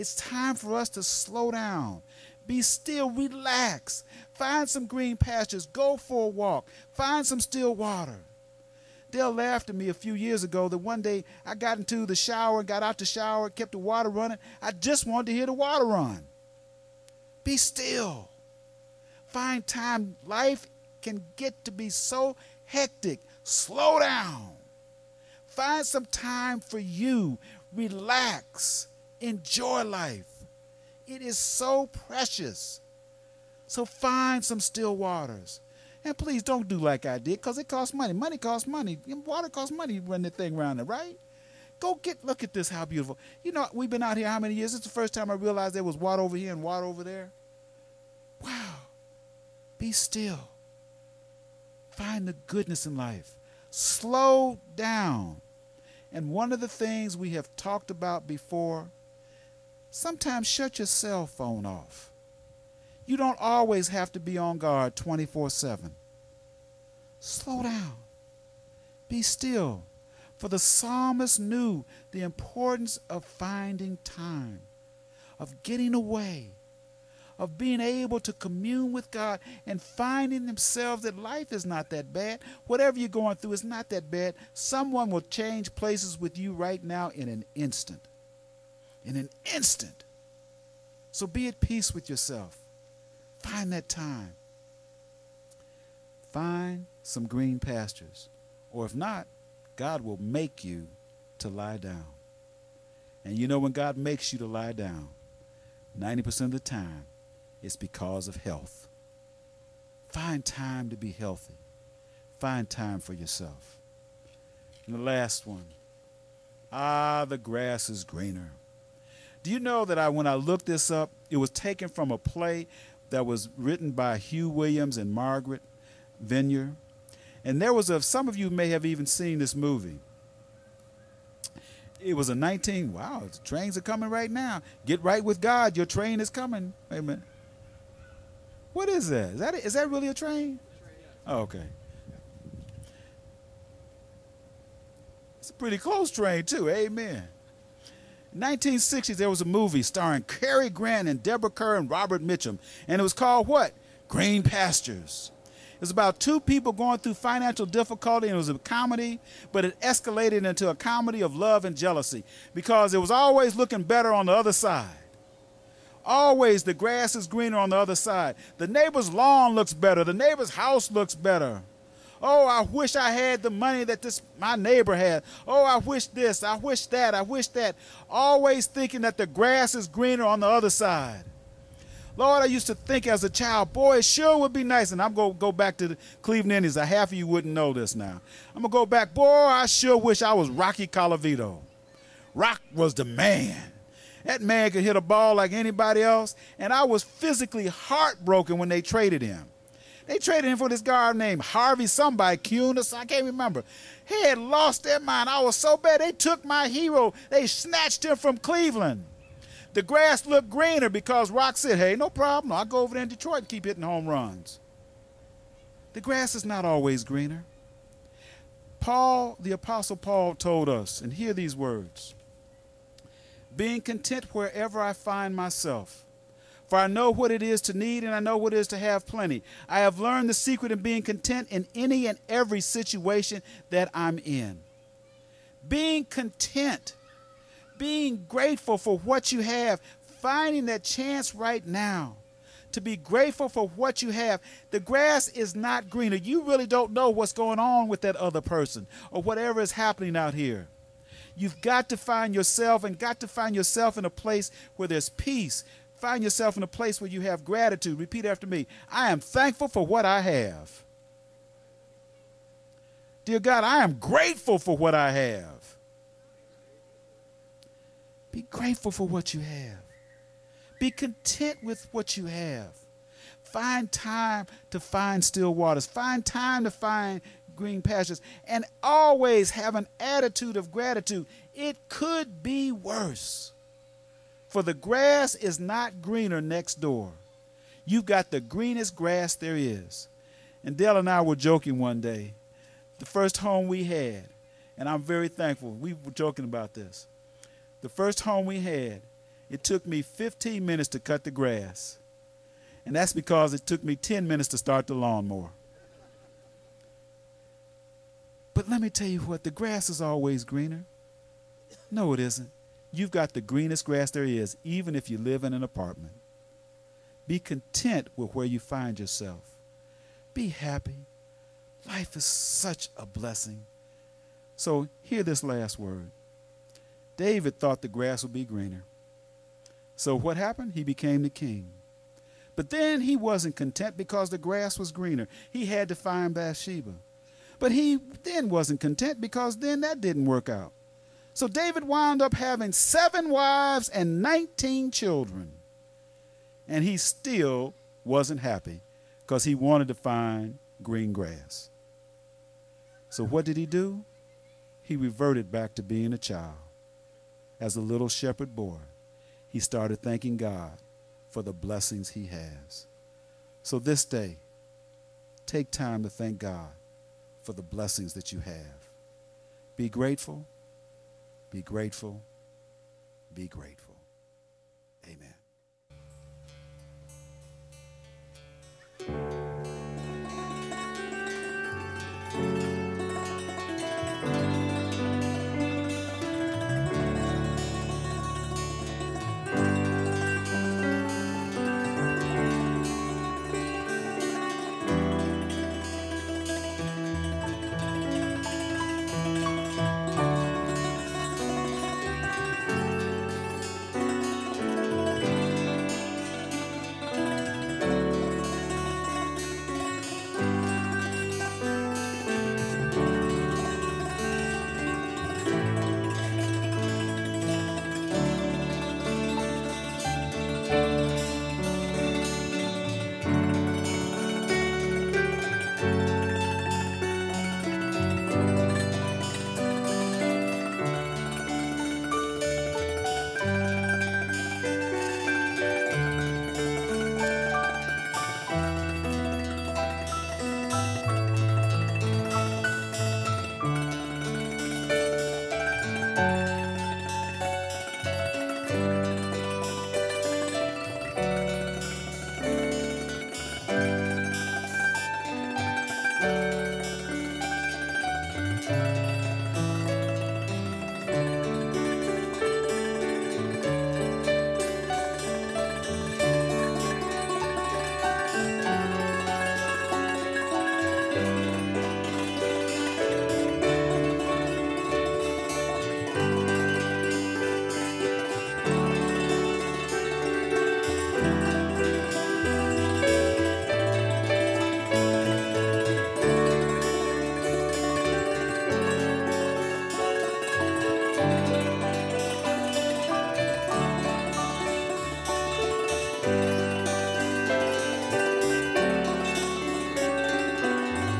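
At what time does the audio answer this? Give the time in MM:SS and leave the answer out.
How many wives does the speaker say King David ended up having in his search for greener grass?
05:42.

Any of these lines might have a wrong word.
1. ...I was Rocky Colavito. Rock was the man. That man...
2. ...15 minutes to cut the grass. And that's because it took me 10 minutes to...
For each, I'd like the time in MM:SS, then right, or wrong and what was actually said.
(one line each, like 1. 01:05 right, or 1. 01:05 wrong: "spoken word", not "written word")
1. 03:10 right
2. 05:00 right.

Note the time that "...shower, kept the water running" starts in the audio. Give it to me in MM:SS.
00:13.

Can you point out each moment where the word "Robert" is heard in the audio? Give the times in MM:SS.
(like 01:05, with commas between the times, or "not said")
02:31.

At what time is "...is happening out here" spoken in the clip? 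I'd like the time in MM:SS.
04:09.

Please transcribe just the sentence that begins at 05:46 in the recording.
And he still wasn't happy because he wanted to find green grass.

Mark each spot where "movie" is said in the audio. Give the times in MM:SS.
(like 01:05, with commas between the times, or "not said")
02:09, 02:29.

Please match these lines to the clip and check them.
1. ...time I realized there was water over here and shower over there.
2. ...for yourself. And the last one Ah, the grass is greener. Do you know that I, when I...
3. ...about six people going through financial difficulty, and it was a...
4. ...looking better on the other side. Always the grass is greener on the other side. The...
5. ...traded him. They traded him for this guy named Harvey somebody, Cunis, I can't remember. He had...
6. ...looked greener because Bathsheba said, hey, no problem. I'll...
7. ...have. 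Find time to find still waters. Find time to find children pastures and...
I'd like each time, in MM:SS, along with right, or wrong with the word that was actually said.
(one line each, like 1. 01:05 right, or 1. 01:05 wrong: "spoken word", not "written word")
1. 00:45 wrong: "water", not "shower"
2. 01:52 right
3. 02:35 wrong: "two", not "six"
4. 02:43 right
5. 03:18 right
6. 03:30 wrong: "Rock", not "Bathsheba"
7. 04:32 wrong: "green", not "children".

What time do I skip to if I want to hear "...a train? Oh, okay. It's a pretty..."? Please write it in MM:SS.
02:20.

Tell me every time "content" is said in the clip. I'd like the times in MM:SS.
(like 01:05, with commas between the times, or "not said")
03:43, 03:51, 03:56, 04:30, 05:17, 05:33, 05:38.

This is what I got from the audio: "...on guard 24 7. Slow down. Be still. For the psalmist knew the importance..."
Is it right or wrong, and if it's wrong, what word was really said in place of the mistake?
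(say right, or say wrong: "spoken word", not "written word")
right.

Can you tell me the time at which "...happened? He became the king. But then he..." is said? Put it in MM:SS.
05:30.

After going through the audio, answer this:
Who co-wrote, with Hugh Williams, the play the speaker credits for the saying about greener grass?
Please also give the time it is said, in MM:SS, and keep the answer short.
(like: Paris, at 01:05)
Margaret Vineyard, at 02:05.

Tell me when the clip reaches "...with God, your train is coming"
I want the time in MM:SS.
02:15.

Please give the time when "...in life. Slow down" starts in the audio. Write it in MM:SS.
00:52.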